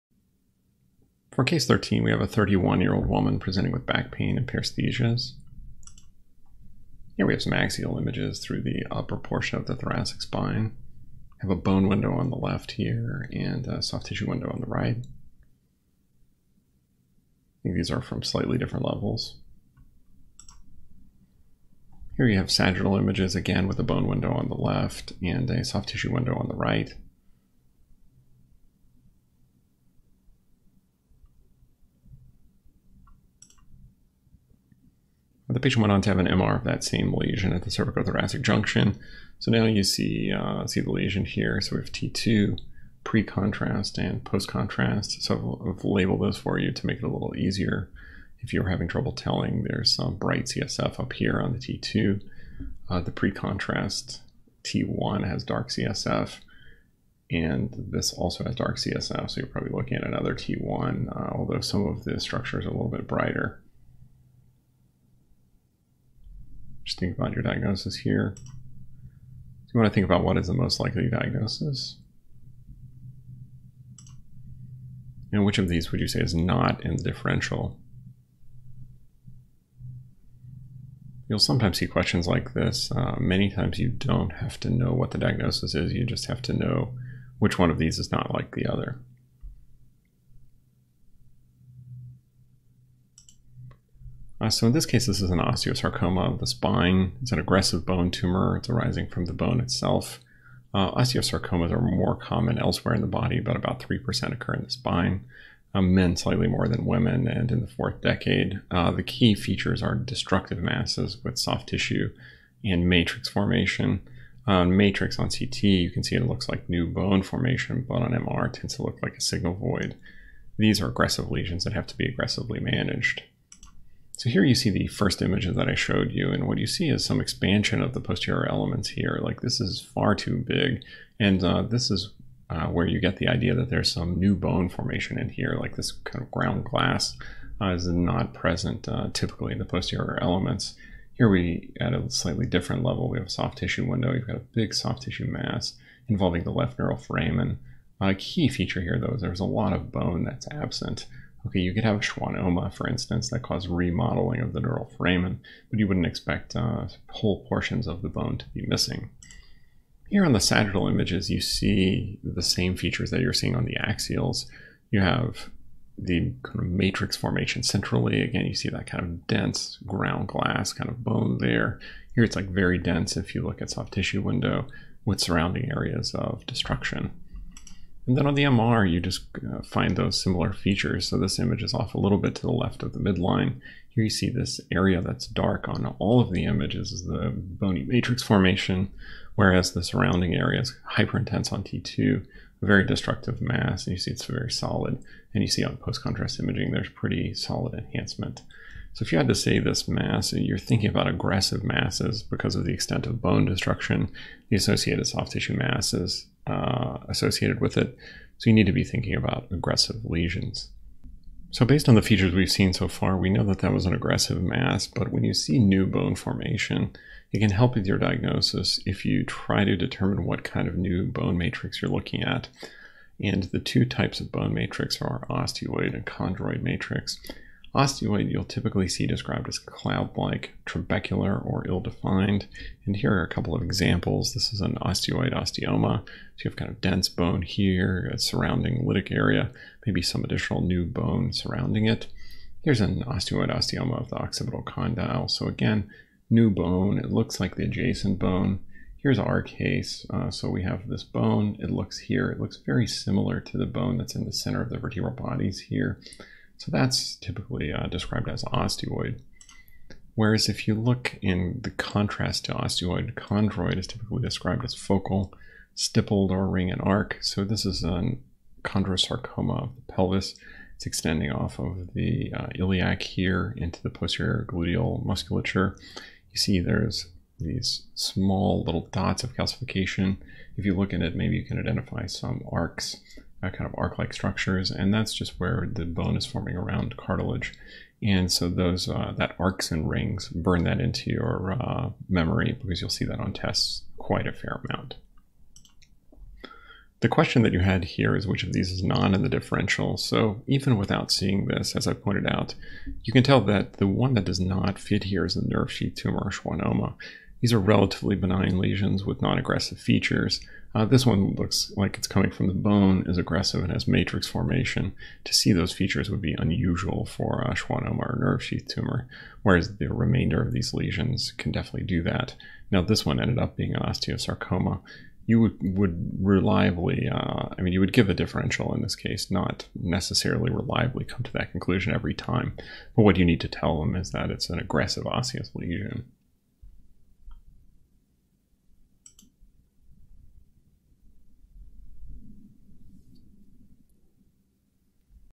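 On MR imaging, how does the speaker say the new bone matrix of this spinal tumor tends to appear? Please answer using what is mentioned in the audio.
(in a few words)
Signal void.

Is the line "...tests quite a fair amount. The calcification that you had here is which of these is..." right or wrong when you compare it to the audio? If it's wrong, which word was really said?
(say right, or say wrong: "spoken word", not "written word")
wrong: "question", not "calcification".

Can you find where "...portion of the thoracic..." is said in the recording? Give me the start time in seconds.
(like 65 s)
9 s.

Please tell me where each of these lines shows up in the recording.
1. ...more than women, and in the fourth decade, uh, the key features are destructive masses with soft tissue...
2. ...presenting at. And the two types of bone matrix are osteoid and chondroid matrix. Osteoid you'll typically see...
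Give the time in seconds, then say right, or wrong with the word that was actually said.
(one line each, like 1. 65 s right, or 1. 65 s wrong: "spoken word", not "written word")
1. 106 s right
2. 221 s wrong: "looking", not "presenting".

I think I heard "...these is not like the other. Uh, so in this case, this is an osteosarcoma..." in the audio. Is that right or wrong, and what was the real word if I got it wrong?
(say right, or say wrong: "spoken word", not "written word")
right.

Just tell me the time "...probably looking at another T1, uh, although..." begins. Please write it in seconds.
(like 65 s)
59 s.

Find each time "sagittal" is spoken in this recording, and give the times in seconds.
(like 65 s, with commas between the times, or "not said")
22 s, 160 s.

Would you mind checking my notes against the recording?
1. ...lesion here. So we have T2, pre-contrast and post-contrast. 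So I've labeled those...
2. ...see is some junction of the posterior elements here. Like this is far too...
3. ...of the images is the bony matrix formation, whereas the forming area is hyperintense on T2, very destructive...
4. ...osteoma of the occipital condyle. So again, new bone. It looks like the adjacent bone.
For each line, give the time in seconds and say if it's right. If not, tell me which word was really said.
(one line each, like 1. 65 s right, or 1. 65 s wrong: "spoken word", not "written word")
1. 40 s right
2. 126 s wrong: "expansion", not "junction"
3. 186 s wrong: "surrounding", not "forming"
4. 243 s right.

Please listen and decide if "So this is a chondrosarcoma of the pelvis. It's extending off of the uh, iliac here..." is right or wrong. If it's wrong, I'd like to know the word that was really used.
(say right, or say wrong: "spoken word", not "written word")
right.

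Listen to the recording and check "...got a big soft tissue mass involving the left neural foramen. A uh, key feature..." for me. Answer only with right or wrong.
right.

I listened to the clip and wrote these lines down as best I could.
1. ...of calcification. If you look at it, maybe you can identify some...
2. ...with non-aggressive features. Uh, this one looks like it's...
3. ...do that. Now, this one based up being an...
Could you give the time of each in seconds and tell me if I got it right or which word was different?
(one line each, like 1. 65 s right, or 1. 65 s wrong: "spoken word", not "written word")
1. 279 s right
2. 309 s right
3. 321 s wrong: "ended", not "based".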